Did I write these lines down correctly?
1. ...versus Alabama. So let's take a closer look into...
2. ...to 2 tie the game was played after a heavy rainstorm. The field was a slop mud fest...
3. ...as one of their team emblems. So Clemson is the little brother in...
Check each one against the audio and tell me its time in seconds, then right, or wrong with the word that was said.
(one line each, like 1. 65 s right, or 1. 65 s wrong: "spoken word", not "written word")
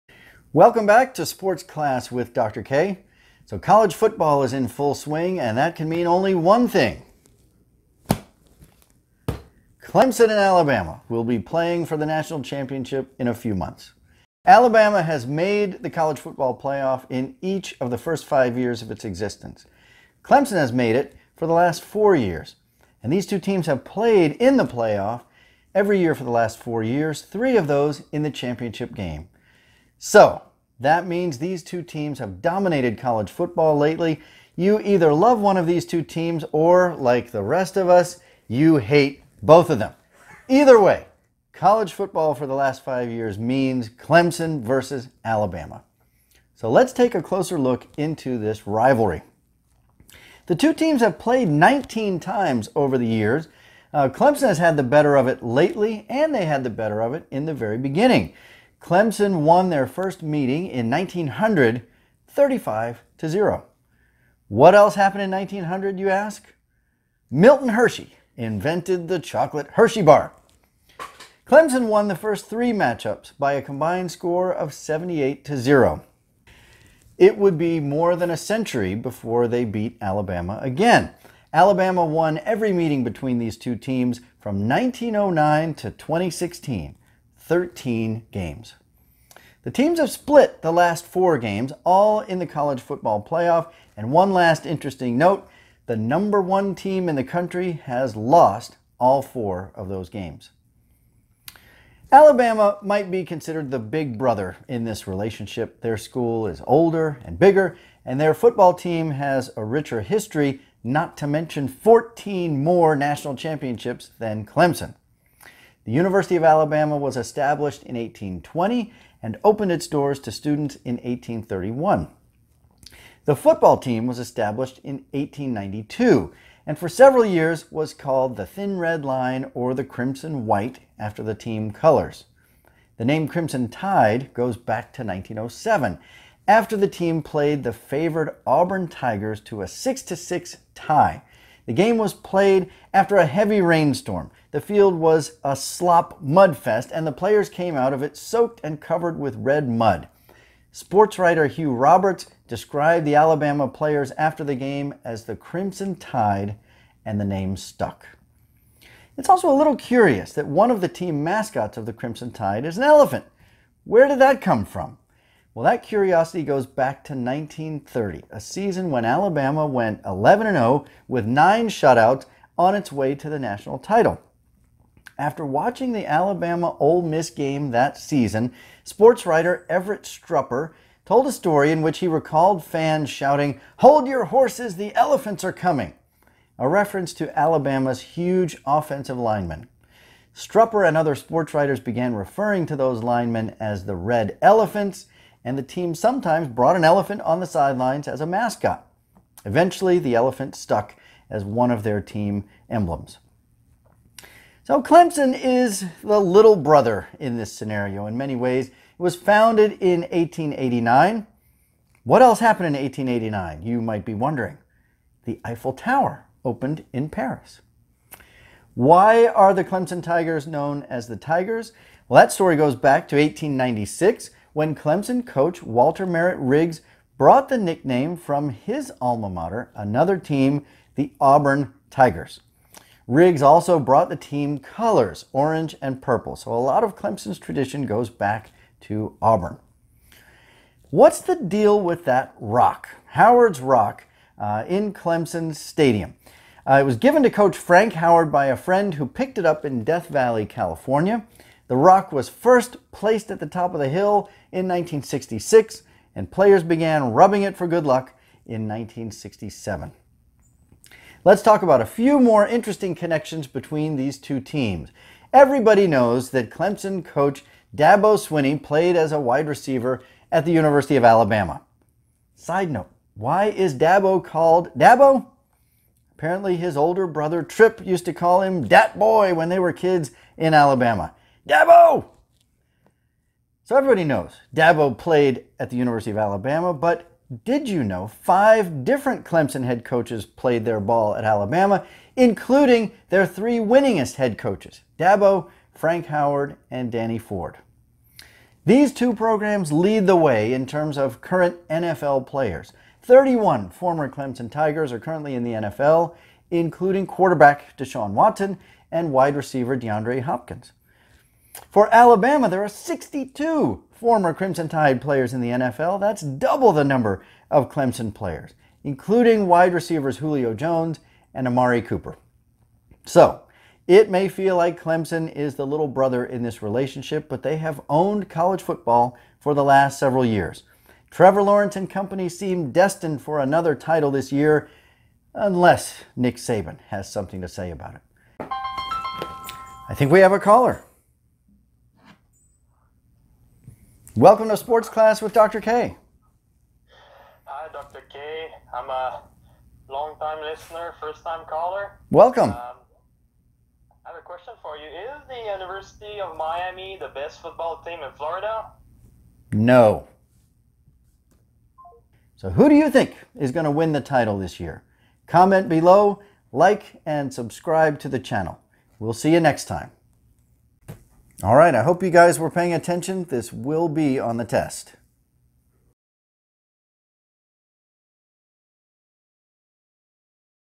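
1. 44 s right
2. 140 s wrong: "6", not "2"
3. 201 s right.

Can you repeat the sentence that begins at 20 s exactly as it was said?
Clemson has made it for the last four years.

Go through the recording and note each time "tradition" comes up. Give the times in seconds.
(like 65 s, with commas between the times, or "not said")
237 s.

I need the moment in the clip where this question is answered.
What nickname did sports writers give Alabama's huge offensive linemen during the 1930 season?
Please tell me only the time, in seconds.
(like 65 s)
193 s.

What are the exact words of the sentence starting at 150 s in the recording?
Sports writer Hugh Roberts described the Alabama players after the game as the Crimson Tide, and the name stuck.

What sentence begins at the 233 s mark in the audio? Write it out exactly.
Riggs also brought the team colors, orange and purple.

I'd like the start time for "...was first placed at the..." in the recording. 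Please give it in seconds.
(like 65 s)
252 s.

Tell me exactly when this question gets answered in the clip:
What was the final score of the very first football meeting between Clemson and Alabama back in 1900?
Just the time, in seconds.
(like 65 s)
62 s.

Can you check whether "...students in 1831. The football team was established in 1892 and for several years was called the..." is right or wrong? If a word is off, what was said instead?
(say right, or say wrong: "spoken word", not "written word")
right.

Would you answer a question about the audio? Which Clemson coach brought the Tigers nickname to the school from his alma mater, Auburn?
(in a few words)
Walter Merritt Riggs.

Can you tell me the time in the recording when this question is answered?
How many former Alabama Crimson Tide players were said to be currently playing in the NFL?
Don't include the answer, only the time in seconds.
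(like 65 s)
312 s.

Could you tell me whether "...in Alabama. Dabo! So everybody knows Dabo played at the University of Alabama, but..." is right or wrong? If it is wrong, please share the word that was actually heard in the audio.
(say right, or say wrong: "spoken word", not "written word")
right.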